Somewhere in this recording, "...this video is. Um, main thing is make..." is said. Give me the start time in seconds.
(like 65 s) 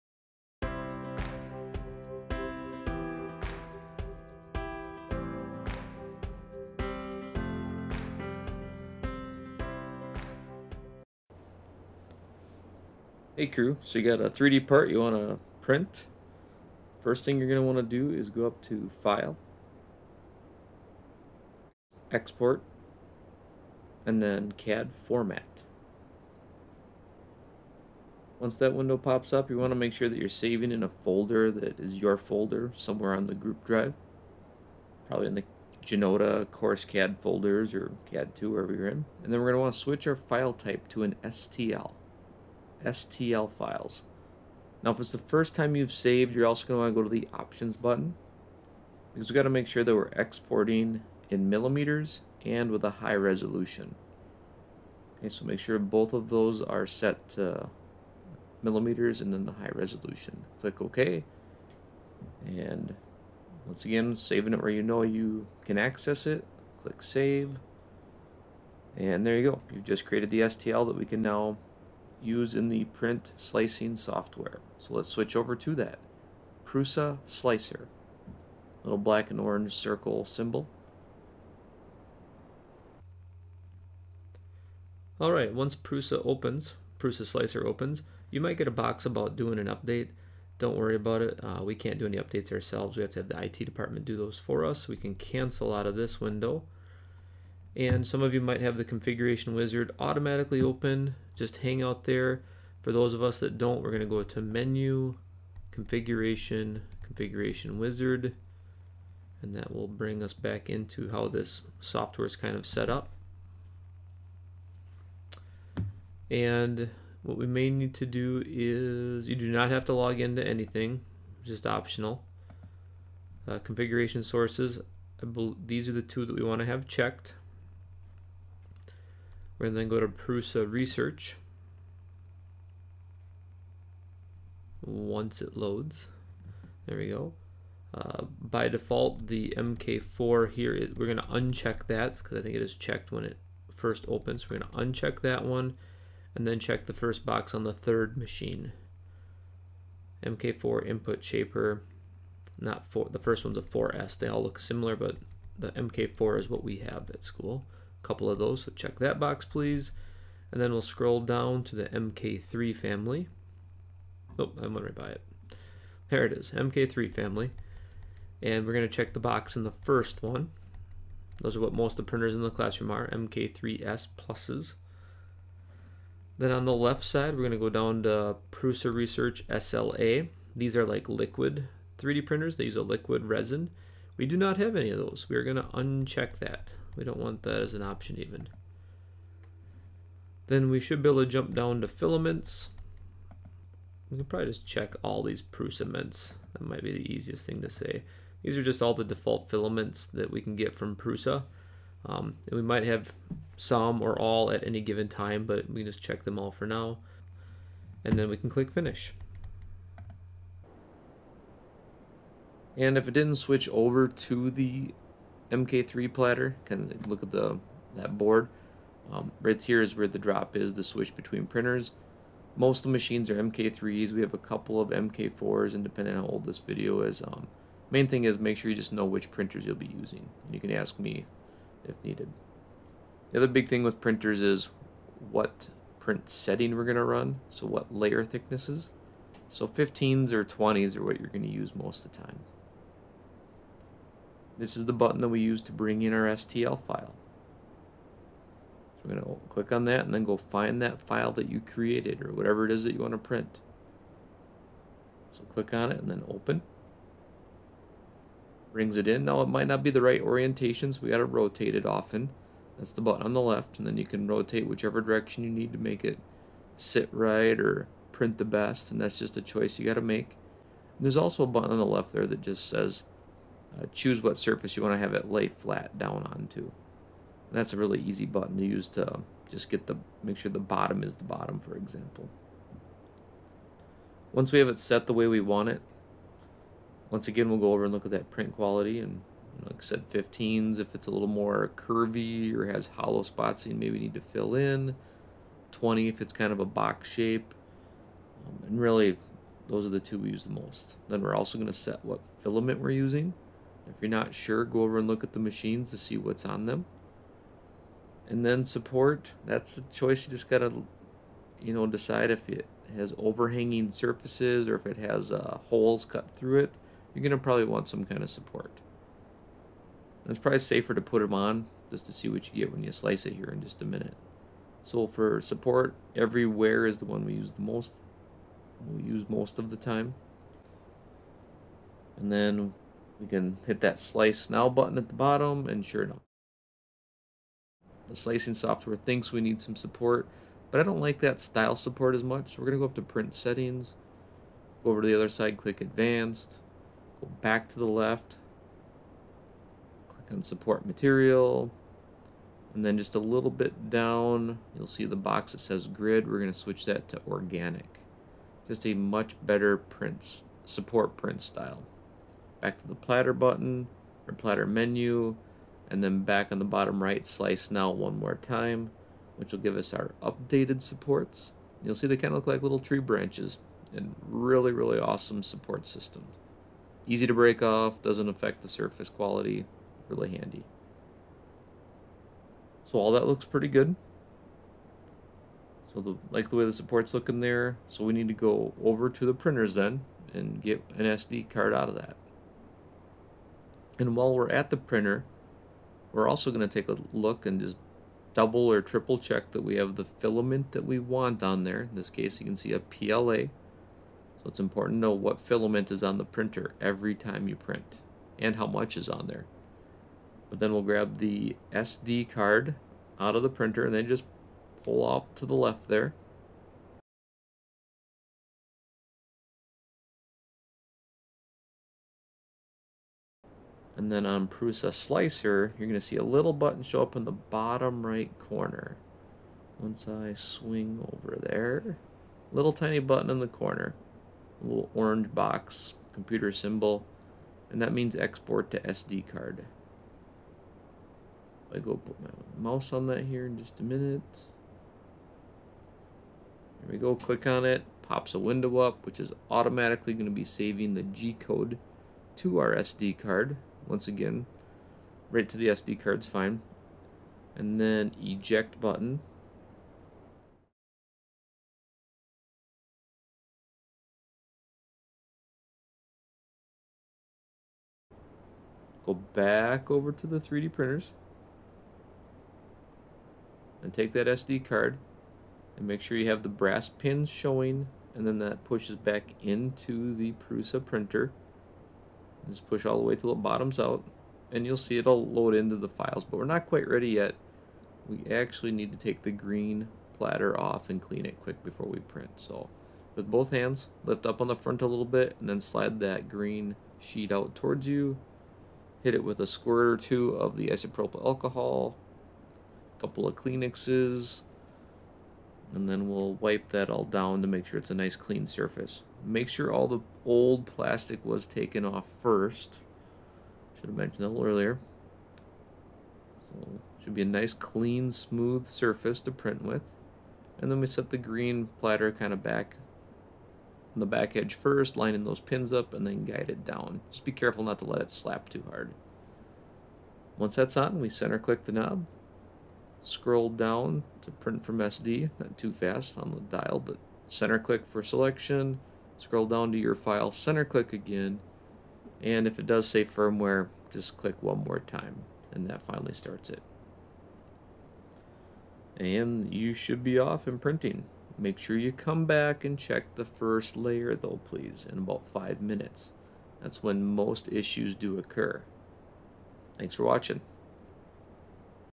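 226 s.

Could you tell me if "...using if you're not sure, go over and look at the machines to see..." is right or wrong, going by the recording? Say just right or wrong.
right.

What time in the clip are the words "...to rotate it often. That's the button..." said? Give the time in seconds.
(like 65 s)
261 s.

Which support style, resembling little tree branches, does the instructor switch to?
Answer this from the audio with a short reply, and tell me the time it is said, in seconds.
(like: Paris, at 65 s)
organic, at 357 s.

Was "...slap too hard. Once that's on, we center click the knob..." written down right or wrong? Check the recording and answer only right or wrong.
right.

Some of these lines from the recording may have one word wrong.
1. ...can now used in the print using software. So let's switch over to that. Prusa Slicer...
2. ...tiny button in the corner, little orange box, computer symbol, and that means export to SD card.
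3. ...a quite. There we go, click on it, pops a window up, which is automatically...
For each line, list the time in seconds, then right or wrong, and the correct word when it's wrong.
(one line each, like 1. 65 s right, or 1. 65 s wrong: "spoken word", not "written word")
1. 71 s wrong: "slicing", not "using"
2. 432 s right
3. 443 s wrong: "minute", not "quite".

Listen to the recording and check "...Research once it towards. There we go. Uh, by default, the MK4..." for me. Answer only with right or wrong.
wrong.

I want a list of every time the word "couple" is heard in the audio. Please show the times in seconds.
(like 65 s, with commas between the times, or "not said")
158 s, 224 s, 503 s.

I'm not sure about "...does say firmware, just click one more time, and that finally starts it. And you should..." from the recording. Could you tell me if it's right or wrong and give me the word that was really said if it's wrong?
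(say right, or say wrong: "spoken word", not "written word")
right.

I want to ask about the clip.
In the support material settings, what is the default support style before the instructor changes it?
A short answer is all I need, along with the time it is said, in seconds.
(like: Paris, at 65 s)
grid, at 355 s.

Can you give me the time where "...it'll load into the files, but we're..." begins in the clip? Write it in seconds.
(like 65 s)
484 s.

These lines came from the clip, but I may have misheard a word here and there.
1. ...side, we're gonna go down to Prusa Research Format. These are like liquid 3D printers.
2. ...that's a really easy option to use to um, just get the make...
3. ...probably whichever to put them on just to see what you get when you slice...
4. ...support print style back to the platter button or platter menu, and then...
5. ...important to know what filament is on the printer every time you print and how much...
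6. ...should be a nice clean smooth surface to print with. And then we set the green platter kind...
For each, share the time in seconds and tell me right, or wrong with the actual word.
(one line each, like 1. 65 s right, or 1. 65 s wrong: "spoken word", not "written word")
1. 177 s wrong: "SLA", not "Format"
2. 277 s wrong: "button", not "option"
3. 320 s wrong: "safer", not "whichever"
4. 360 s right
5. 404 s right
6. 517 s right.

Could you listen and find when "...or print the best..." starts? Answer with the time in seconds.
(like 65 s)
267 s.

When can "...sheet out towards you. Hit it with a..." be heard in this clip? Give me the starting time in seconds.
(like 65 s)
496 s.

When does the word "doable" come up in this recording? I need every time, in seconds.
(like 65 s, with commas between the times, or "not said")
not said.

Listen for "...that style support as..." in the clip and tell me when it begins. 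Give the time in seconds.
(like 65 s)
341 s.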